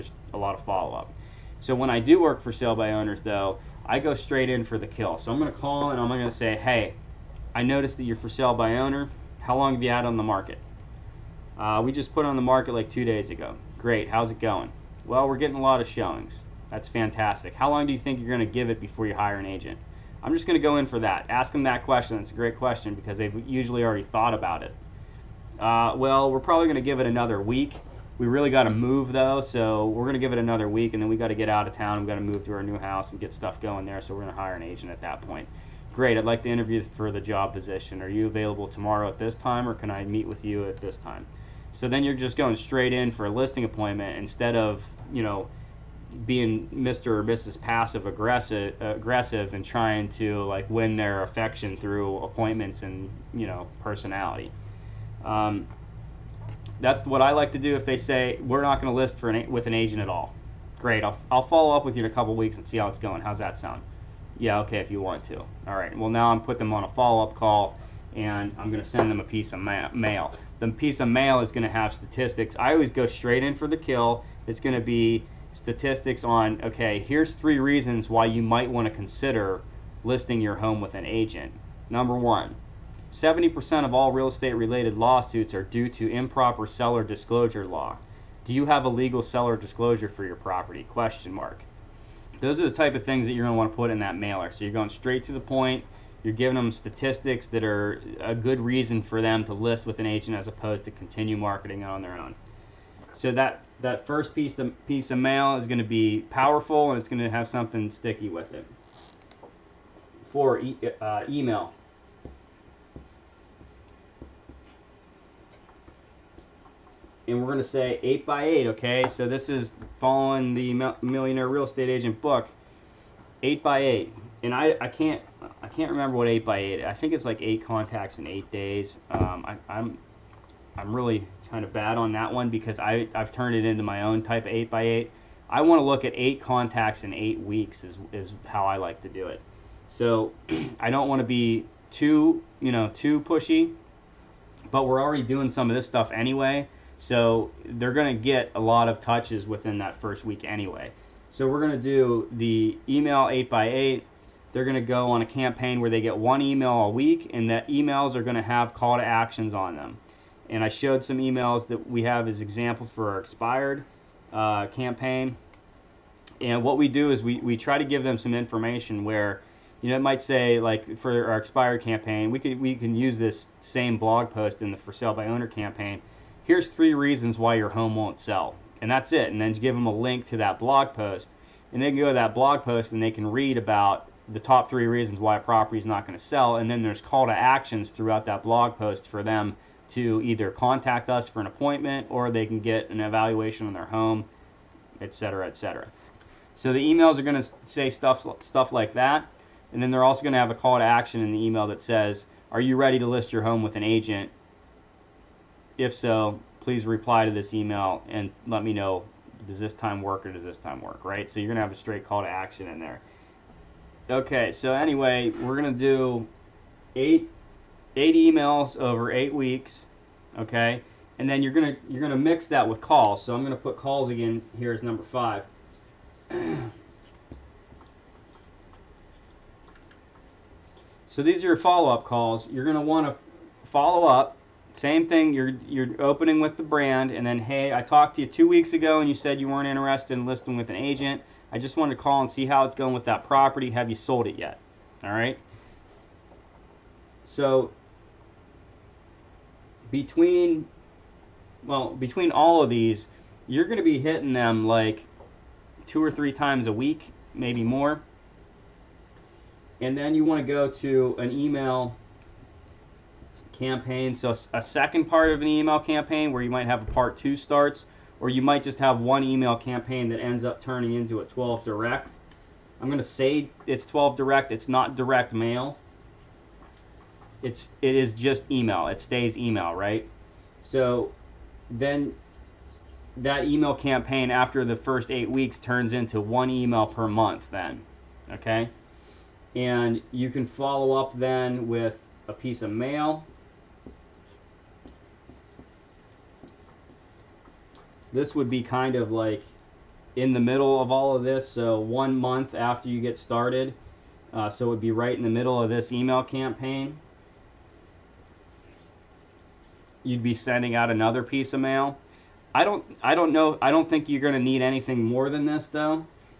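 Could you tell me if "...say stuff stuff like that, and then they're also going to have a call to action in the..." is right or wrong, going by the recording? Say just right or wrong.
right.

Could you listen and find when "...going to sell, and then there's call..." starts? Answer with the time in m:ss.
3:06.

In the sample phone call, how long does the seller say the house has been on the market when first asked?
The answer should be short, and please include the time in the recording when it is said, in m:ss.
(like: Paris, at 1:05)
2 days, at 0:12.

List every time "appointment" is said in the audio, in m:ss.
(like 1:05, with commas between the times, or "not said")
0:43, 0:52, 3:11.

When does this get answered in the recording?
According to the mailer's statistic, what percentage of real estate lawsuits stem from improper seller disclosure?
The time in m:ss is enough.
1:23.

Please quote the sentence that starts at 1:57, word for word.
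And we're going to say 8 by 8 okay?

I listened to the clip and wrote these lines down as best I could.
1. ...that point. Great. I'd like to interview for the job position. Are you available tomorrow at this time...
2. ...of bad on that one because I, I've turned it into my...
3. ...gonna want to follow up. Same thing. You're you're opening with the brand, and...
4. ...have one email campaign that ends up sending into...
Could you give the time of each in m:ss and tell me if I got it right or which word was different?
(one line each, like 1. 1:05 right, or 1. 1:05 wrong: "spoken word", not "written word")
1. 0:35 right
2. 2:11 right
3. 3:52 right
4. 4:28 wrong: "turning", not "sending".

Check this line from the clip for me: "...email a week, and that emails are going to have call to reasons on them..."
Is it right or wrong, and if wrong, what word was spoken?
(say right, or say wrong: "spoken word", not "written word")
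wrong: "actions", not "reasons".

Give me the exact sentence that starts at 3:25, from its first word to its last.
If so, please reply to this email and let me know does this time work or does this time work, right?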